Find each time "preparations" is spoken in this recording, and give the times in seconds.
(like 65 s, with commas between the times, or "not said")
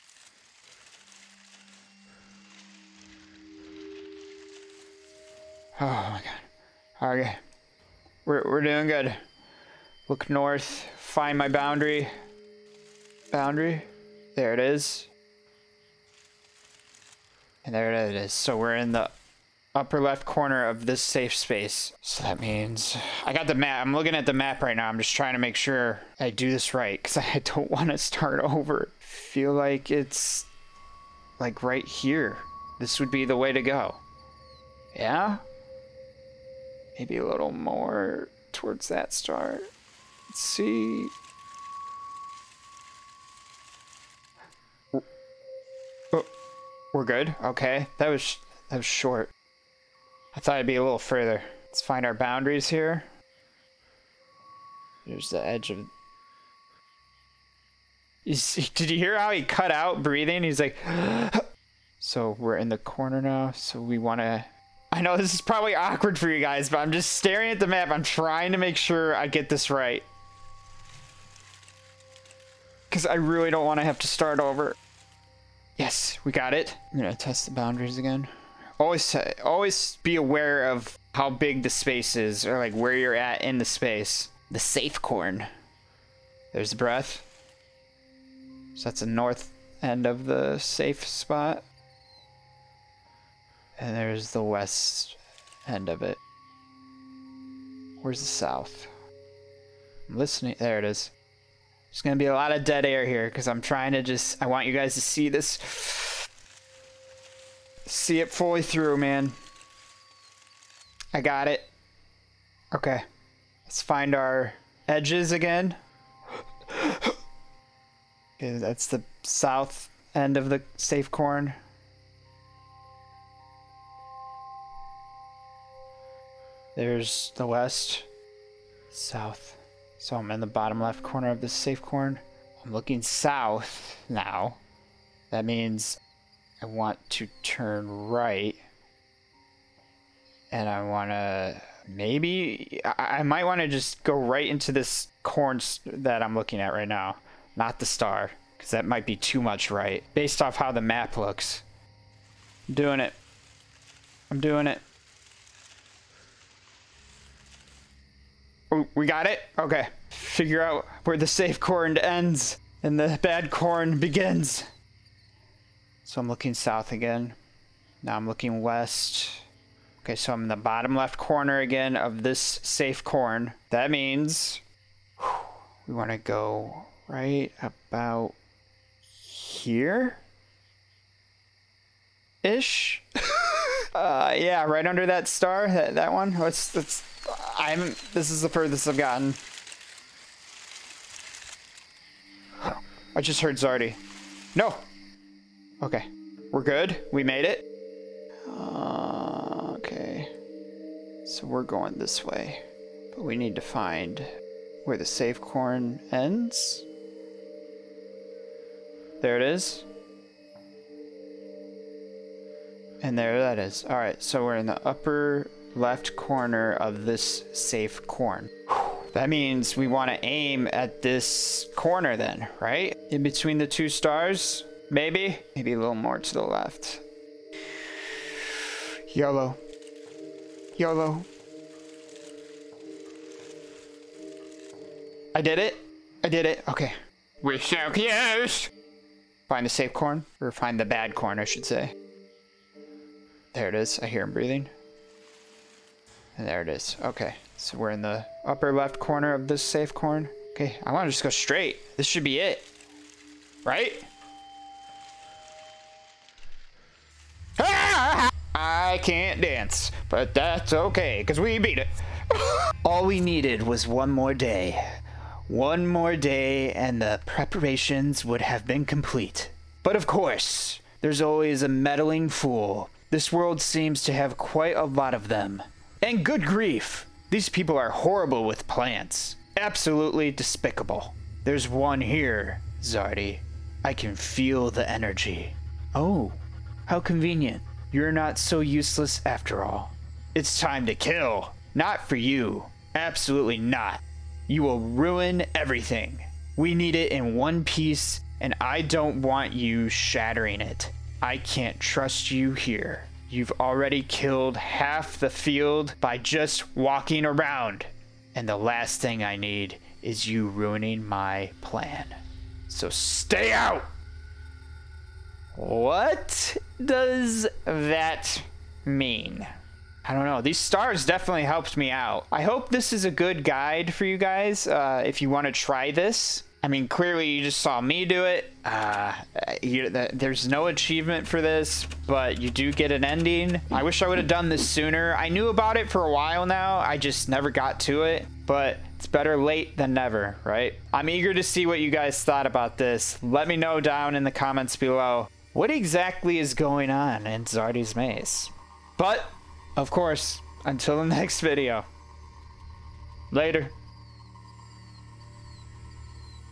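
267 s.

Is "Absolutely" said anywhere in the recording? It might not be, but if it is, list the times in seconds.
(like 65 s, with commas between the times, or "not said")
279 s, 292 s.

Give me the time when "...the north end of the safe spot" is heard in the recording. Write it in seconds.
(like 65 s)
88 s.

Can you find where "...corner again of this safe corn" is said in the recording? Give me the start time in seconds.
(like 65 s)
171 s.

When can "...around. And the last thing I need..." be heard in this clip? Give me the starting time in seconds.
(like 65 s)
307 s.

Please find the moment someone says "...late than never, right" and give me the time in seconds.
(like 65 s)
339 s.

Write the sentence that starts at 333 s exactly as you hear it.
I wish I would have done this sooner.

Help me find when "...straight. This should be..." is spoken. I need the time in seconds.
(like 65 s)
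251 s.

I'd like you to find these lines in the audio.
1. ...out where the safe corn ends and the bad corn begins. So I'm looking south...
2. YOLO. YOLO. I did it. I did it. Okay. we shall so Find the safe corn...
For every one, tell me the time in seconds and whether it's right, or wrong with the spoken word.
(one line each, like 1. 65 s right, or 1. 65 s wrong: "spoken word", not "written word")
1. 160 s right
2. 229 s right.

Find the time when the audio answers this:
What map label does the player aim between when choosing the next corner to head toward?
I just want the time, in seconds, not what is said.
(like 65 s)
223 s.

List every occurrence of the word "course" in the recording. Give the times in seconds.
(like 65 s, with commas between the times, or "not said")
270 s, 349 s.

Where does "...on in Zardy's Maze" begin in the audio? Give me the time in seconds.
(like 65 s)
346 s.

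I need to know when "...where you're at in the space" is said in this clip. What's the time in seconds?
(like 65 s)
82 s.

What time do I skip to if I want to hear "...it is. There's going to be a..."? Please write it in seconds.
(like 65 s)
100 s.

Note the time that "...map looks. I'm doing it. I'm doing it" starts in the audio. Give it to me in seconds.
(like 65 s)
150 s.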